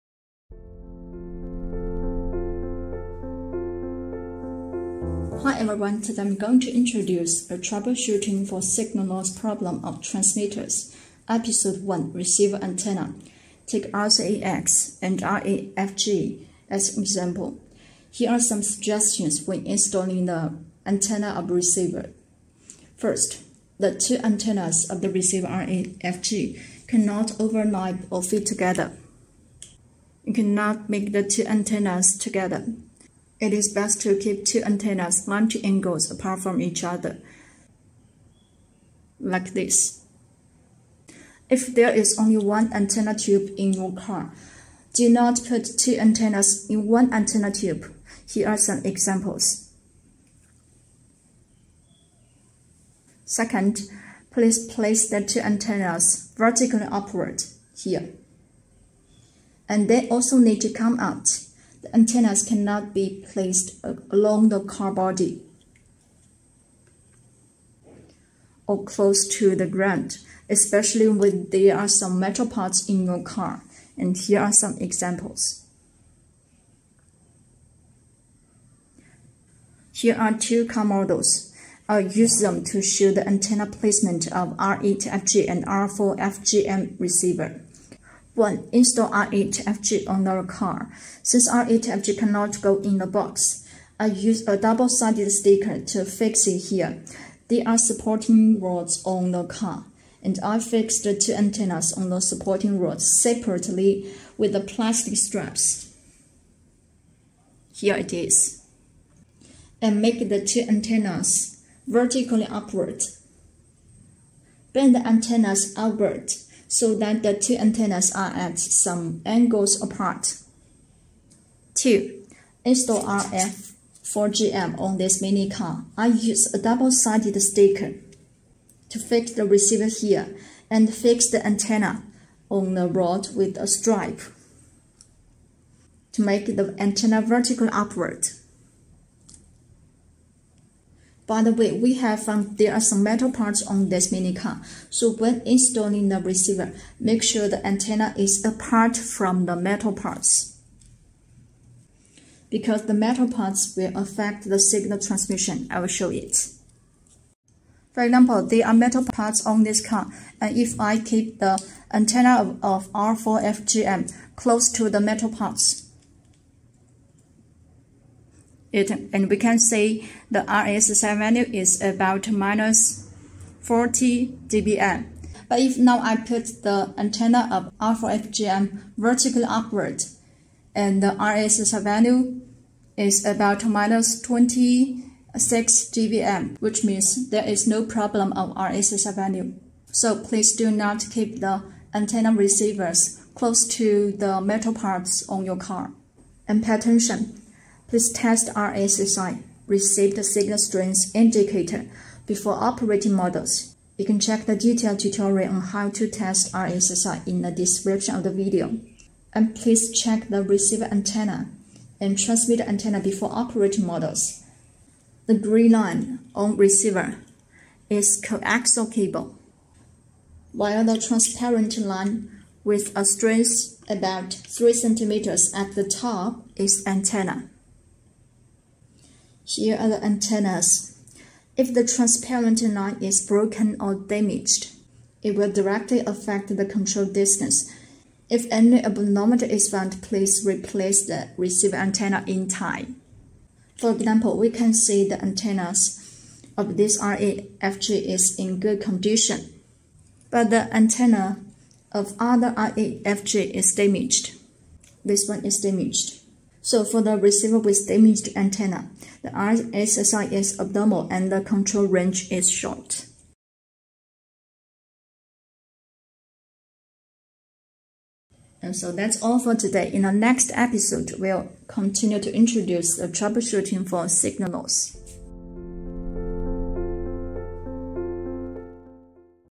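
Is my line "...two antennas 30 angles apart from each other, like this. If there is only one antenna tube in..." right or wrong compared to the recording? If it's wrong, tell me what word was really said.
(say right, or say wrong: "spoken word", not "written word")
wrong: "90", not "30".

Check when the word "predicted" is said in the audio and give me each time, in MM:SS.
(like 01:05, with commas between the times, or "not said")
not said.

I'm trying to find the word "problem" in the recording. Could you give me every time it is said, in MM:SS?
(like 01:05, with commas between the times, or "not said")
00:09, 03:07.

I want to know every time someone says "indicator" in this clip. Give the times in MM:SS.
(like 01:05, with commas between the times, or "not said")
03:21.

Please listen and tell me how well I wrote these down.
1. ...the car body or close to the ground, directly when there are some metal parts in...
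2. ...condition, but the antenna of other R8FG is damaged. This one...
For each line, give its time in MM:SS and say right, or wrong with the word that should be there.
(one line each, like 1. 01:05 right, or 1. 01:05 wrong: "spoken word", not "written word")
1. 01:04 wrong: "especially", not "directly"
2. 04:08 right.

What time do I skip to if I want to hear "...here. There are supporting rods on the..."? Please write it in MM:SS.
01:36.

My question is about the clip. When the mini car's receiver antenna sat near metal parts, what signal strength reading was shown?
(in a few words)
-40 dBm.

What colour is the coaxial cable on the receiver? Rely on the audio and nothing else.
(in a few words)
Green.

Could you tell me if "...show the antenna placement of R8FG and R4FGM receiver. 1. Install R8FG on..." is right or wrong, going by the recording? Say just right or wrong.
right.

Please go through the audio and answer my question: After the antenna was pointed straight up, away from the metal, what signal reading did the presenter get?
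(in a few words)
-26 dBm.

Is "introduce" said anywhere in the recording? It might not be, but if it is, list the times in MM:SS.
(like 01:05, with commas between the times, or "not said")
00:06, 04:32.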